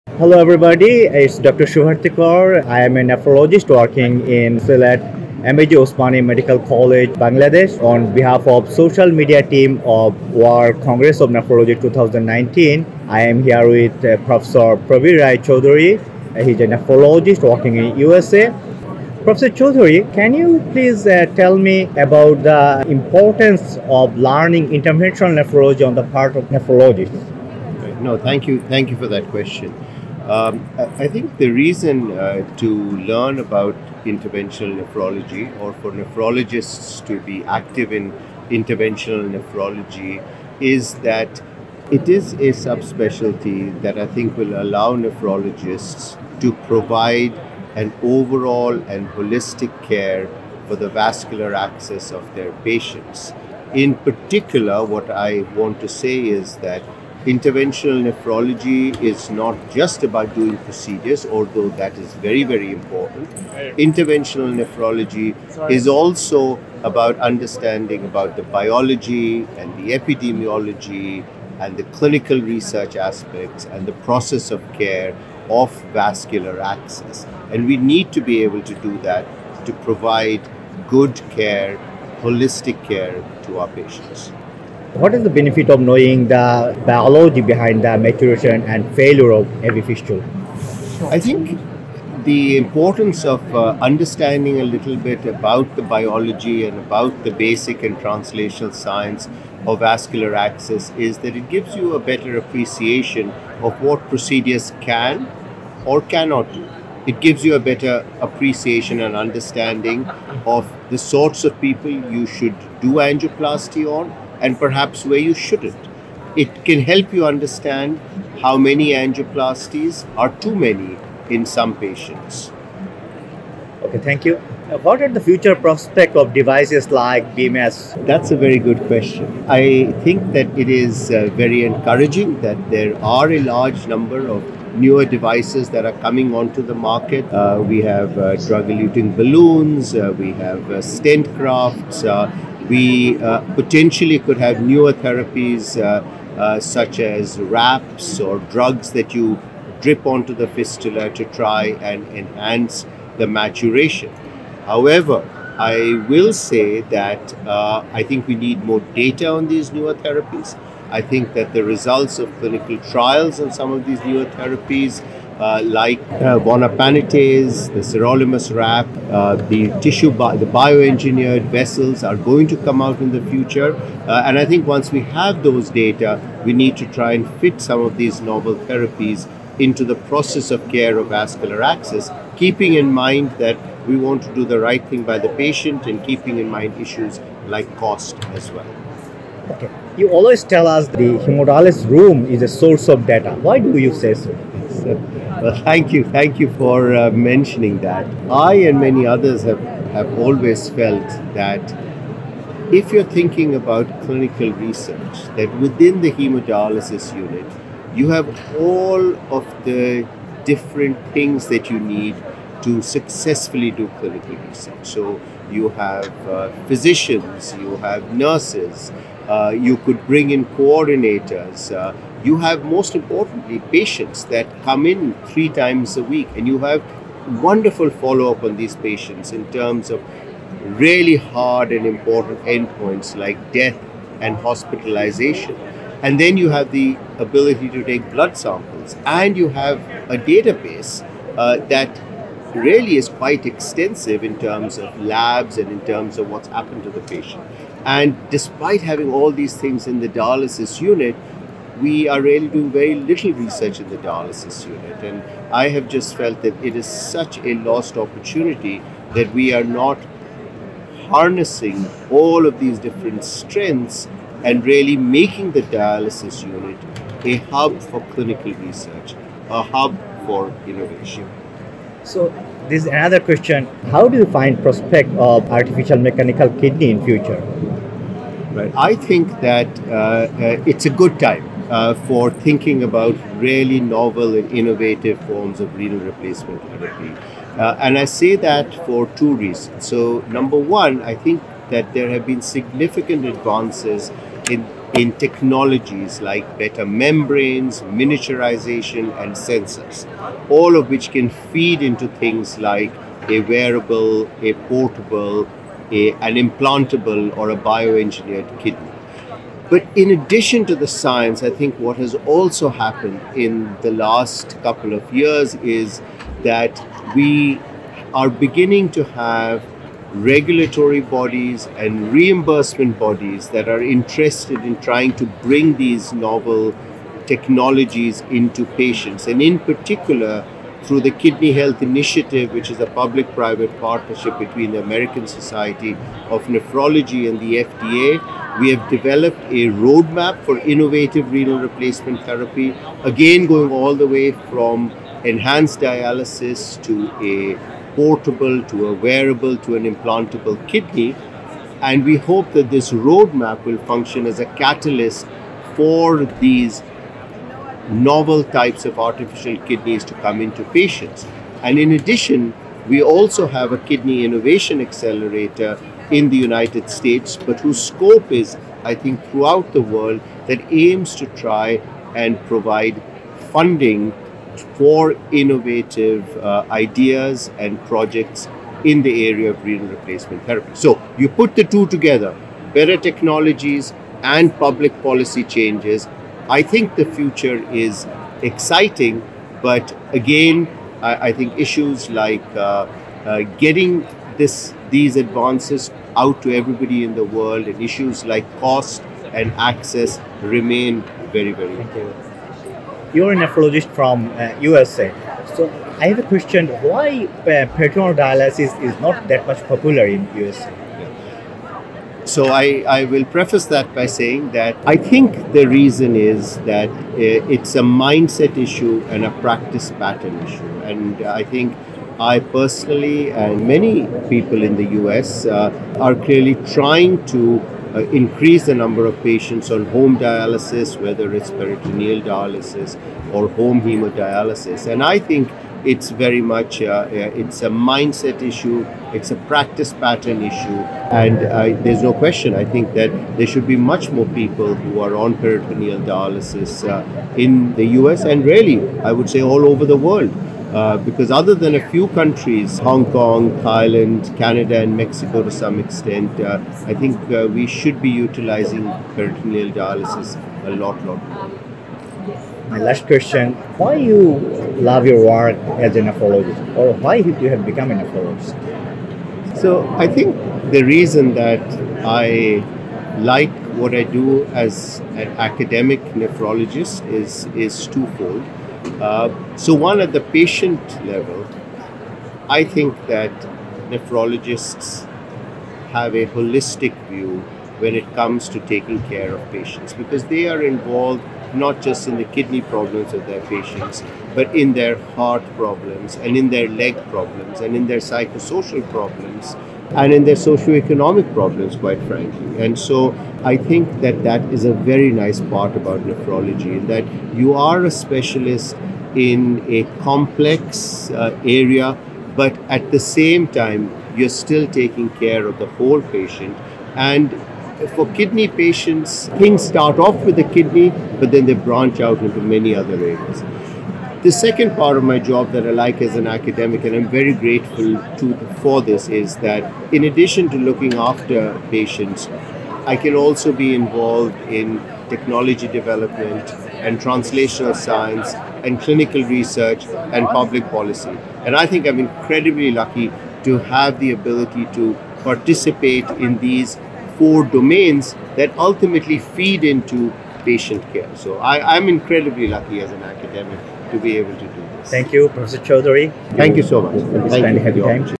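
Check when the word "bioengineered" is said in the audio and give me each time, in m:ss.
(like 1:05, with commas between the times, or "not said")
2:50, 5:07.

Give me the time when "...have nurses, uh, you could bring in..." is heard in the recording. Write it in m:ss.
3:37.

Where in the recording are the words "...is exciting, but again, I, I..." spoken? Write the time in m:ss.
6:27.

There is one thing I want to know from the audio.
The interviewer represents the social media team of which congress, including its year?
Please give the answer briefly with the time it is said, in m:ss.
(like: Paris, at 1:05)
World Congress of Nephrology 2019, at 0:10.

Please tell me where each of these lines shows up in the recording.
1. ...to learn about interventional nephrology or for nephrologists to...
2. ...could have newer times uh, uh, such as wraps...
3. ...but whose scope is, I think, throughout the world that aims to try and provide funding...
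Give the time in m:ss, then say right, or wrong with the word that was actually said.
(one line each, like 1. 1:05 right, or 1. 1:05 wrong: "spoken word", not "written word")
1. 0:32 right
2. 2:24 wrong: "therapies", not "times"
3. 6:07 right.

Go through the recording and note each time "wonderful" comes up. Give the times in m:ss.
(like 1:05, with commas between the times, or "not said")
3:47.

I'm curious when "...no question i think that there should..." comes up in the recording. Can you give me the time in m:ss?
7:22.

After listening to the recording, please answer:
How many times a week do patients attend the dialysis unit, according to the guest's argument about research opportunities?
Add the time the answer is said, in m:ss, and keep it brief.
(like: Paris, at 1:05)
3, at 3:45.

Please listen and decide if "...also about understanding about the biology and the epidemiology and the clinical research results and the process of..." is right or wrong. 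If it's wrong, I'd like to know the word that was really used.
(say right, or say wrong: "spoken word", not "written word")
wrong: "aspects", not "results".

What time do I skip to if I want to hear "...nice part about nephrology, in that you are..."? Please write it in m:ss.
8:25.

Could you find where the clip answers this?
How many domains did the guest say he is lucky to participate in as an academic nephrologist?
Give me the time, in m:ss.
9:07.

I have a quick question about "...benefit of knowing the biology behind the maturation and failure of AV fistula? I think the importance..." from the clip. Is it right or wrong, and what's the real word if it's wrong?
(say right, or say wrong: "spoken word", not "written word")
right.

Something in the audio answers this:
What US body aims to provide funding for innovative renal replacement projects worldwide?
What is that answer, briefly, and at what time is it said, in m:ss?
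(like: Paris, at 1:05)
kidney innovation accelerator, at 6:03.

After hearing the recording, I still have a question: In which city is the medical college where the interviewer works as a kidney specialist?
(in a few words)
Sylhet.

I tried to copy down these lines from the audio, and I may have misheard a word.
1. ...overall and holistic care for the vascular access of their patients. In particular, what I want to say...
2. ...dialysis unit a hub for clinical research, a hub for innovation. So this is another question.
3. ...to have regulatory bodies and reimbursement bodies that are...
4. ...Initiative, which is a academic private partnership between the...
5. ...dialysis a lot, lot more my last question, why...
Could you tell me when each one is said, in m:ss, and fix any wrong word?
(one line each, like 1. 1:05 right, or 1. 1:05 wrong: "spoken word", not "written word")
1. 0:48 right
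2. 4:25 right
3. 5:18 right
4. 5:31 wrong: "public", not "academic"
5. 7:39 right.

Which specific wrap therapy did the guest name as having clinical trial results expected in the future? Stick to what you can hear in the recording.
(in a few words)
sirolimus wrap.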